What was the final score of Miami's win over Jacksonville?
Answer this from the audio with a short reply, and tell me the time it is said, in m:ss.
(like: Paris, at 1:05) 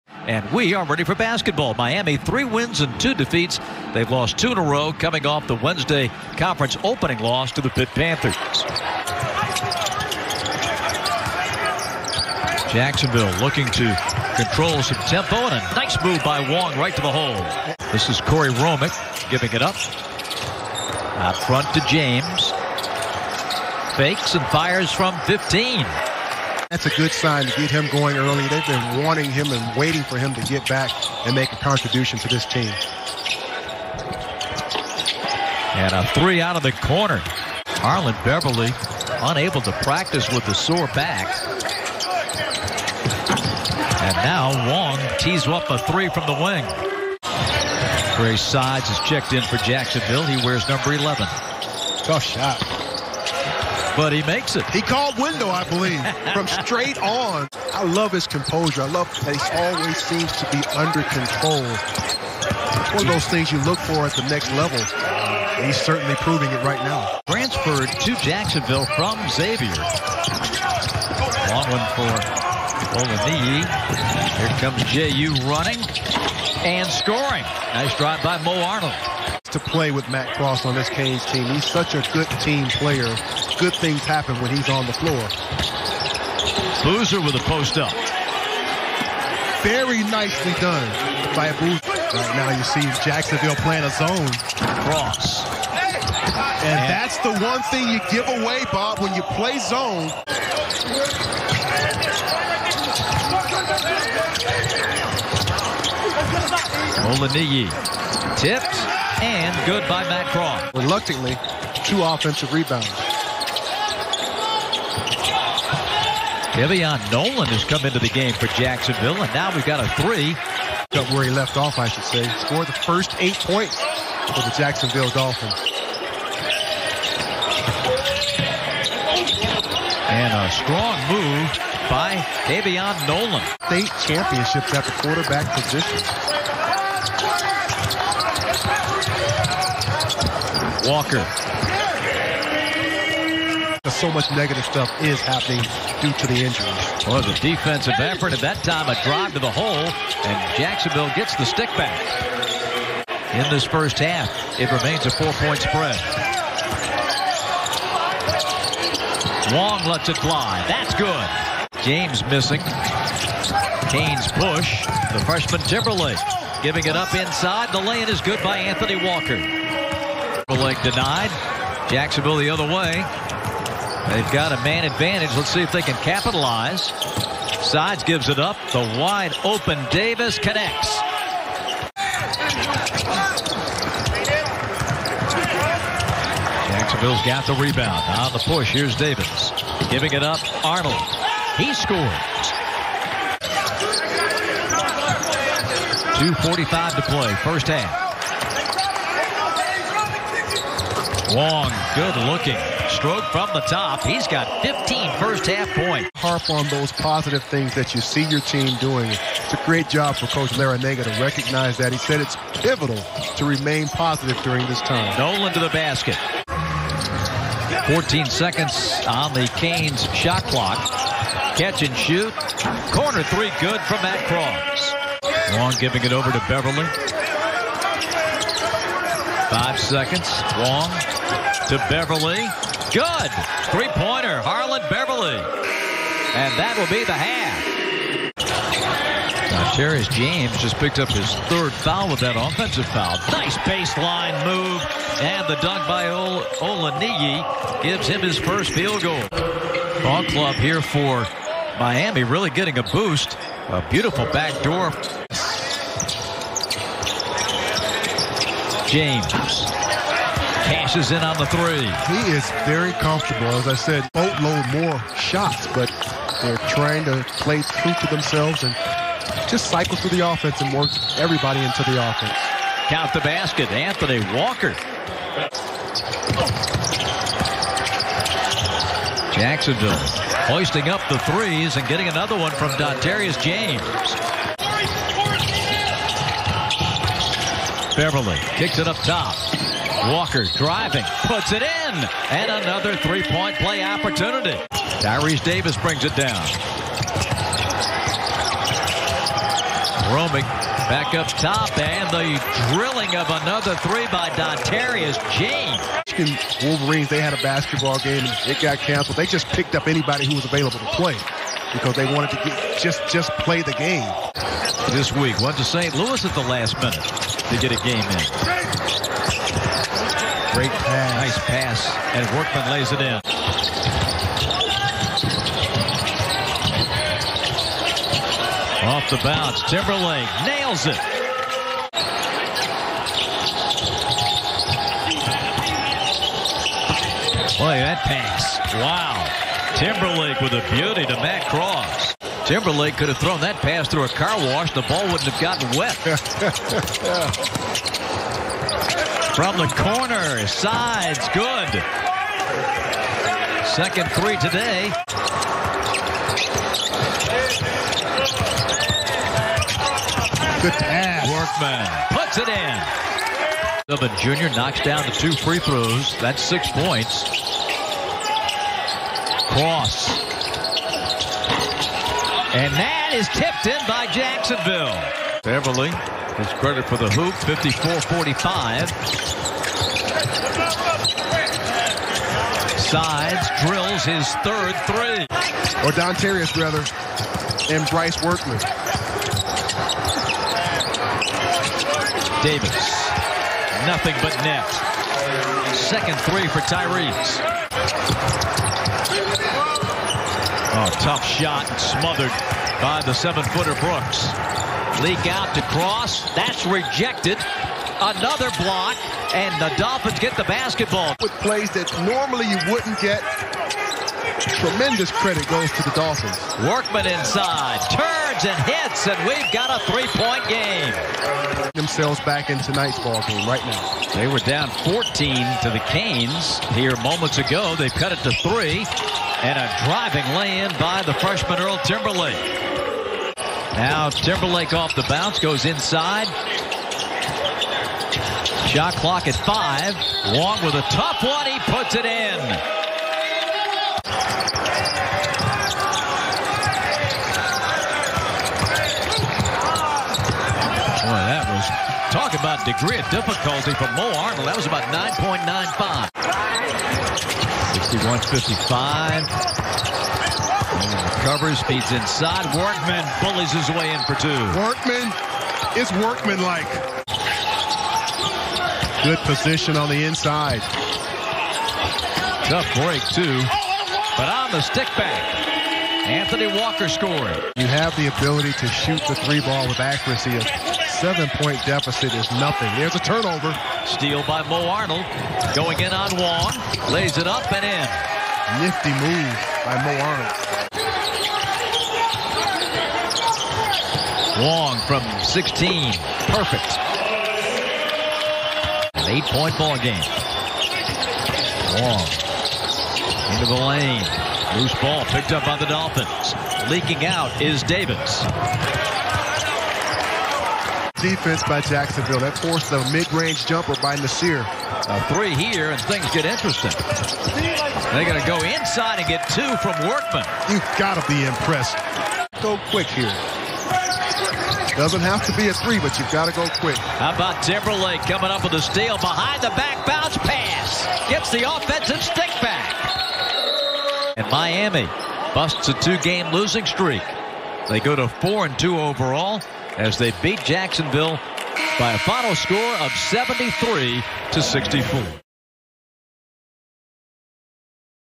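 73 to 64, at 9:02.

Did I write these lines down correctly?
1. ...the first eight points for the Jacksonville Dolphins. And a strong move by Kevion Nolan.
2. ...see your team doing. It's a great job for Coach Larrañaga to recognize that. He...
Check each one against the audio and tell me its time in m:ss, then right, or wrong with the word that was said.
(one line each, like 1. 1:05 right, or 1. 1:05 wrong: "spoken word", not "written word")
1. 2:02 right
2. 3:28 right.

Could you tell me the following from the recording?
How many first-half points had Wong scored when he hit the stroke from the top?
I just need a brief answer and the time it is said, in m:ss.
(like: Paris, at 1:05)
15, at 3:24.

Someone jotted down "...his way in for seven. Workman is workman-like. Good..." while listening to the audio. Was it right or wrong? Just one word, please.
wrong.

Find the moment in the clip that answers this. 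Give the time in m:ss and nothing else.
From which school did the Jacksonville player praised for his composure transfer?
1:09.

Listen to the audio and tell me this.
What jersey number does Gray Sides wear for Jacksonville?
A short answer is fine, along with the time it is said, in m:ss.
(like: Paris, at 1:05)
11, at 0:50.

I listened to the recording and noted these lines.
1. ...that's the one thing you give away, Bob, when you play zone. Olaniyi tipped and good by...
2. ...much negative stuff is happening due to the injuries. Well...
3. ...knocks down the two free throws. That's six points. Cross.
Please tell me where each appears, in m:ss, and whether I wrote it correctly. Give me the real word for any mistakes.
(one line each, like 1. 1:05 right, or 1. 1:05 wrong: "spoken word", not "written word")
1. 1:36 right
2. 2:24 right
3. 6:04 right.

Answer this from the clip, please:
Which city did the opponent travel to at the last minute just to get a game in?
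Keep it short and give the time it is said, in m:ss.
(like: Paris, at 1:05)
St. Louis, at 5:15.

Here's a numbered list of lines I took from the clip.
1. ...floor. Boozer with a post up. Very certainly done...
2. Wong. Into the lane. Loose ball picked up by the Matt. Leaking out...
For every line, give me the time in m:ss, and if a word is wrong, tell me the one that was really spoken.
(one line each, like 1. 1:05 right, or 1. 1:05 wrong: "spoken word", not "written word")
1. 1:24 wrong: "nicely", not "certainly"
2. 8:21 wrong: "Dolphins", not "Matt".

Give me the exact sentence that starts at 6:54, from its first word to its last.
Tremendous credit goes to the Dolphins.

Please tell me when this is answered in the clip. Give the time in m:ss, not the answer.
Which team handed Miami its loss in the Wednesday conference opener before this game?
0:07.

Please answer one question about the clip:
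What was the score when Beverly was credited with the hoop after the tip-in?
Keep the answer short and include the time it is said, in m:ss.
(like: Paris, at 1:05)
54-45, at 6:17.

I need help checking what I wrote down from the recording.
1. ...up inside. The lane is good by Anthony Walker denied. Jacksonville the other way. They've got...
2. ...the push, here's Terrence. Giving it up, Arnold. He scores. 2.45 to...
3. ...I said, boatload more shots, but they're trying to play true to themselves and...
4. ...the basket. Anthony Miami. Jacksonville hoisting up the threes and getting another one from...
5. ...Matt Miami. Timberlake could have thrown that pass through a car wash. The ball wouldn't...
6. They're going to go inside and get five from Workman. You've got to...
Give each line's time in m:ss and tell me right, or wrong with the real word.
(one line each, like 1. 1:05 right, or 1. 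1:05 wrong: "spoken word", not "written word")
1. 2:46 right
2. 3:08 wrong: "Davis", not "Terrence"
3. 4:23 right
4. 4:33 wrong: "Walker", not "Miami"
5. 5:41 wrong: "Cross", not "Miami"
6. 8:37 wrong: "two", not "five".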